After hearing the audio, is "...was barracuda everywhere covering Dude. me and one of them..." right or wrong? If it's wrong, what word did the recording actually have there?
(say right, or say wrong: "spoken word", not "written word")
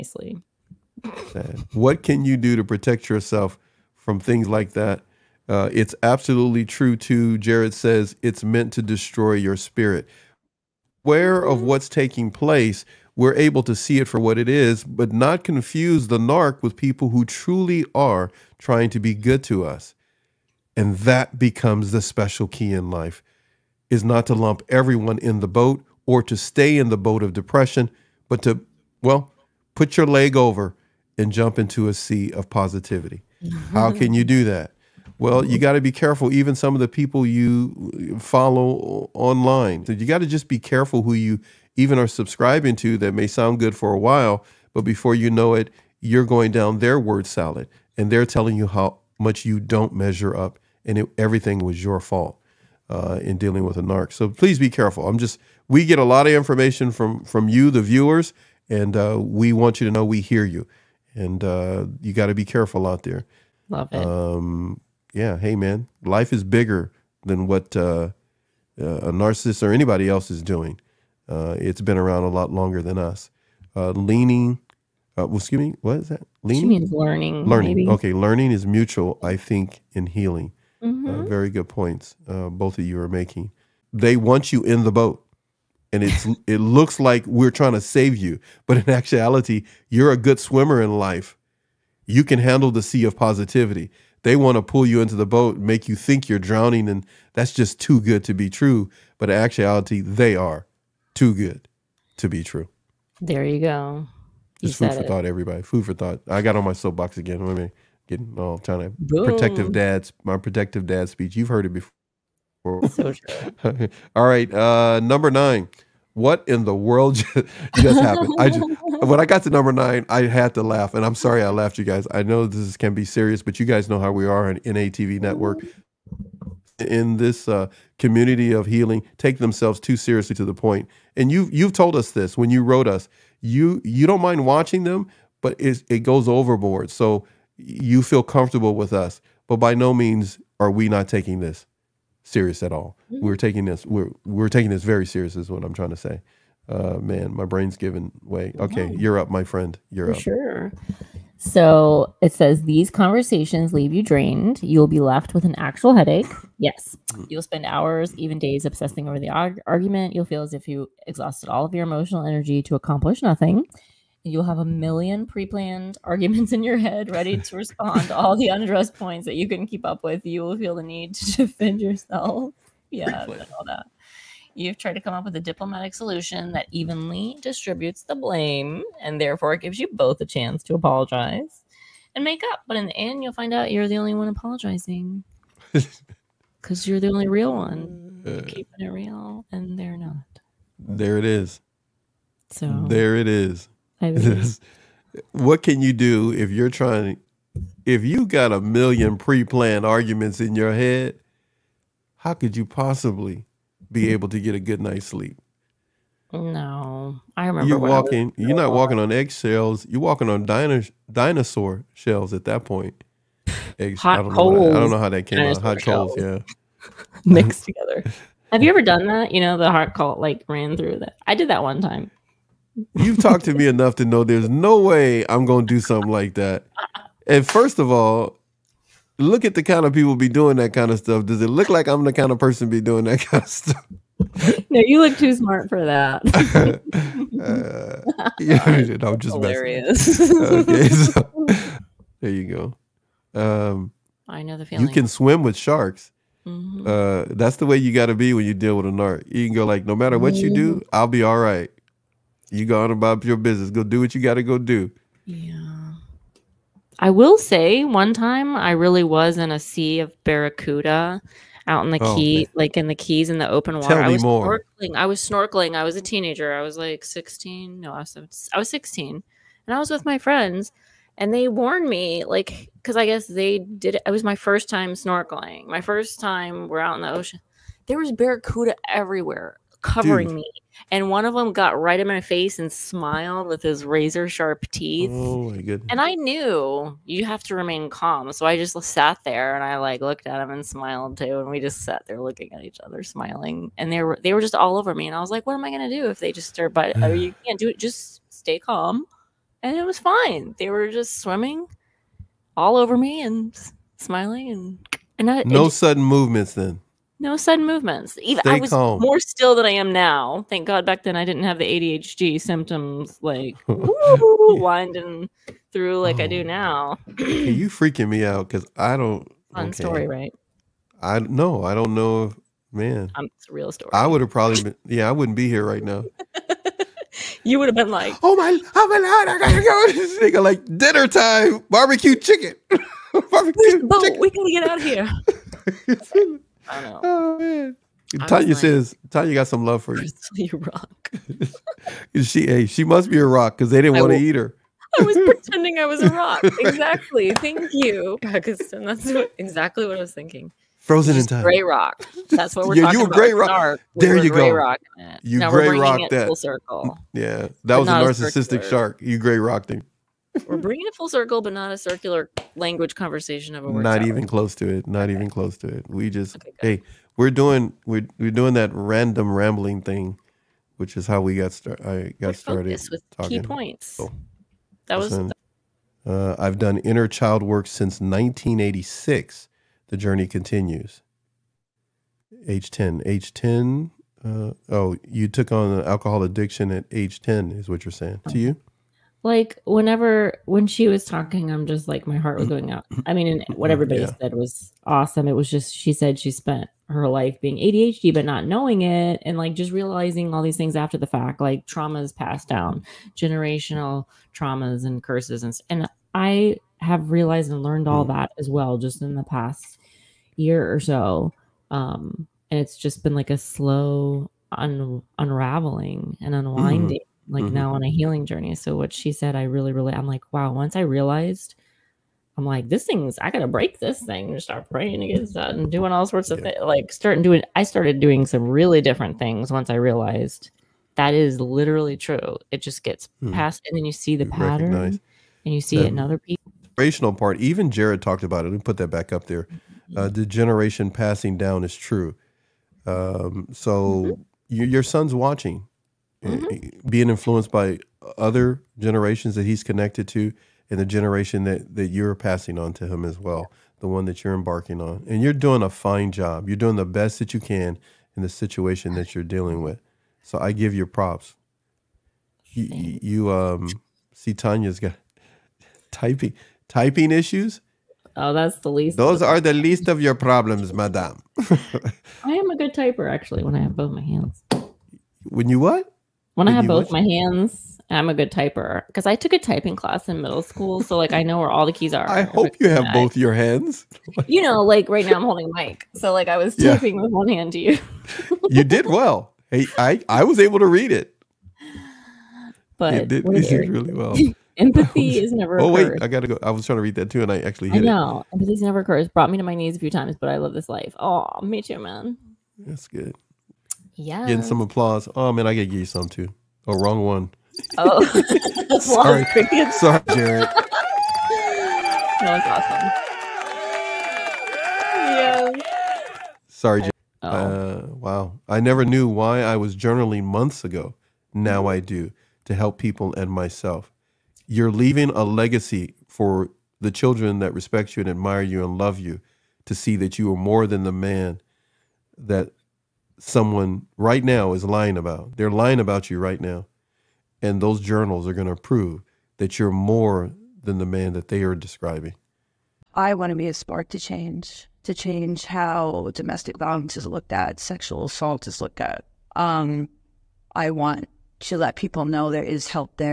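right.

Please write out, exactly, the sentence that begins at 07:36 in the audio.
You're doing the best that you can in the situation that you're dealing with.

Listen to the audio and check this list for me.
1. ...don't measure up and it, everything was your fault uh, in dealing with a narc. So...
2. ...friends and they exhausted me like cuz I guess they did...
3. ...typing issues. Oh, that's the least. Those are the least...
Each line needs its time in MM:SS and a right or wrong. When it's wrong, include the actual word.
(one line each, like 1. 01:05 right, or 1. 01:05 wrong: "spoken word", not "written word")
1. 00:49 right
2. 04:30 wrong: "warned", not "exhausted"
3. 07:46 right.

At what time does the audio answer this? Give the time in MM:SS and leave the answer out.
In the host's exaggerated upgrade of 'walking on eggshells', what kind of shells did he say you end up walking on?
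03:31.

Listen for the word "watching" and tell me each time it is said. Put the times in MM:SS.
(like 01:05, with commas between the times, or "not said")
02:14, 07:25.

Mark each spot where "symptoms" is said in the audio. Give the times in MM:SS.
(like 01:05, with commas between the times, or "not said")
05:12.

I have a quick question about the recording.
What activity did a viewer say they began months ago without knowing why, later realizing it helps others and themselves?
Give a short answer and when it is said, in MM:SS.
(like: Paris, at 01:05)
Journaling, at 08:39.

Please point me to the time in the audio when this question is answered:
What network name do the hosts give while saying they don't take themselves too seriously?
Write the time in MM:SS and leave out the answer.
02:04.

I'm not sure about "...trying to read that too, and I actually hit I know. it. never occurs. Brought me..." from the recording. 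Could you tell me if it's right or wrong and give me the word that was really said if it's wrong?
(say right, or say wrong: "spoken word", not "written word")
right.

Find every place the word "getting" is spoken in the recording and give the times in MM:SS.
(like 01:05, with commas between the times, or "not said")
01:48, 08:24.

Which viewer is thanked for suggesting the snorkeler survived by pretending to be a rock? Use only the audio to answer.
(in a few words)
Paxton.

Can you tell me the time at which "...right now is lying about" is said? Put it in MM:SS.
08:53.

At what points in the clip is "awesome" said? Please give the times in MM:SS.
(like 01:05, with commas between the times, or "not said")
06:34, 08:33.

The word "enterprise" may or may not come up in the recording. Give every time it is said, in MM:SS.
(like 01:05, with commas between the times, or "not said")
not said.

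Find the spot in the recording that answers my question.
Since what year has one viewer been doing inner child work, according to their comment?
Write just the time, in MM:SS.
06:18.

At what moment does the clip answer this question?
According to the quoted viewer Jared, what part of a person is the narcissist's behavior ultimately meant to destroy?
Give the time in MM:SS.
00:09.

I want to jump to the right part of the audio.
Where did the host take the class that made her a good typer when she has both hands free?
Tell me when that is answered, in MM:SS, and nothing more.
08:00.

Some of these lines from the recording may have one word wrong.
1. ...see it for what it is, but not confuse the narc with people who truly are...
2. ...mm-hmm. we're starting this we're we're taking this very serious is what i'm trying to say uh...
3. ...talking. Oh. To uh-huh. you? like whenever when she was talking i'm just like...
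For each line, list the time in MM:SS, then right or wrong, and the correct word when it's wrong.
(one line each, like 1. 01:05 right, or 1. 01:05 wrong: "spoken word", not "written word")
1. 00:13 right
2. 02:23 wrong: "taking", not "starting"
3. 06:27 wrong: "saying", not "talking".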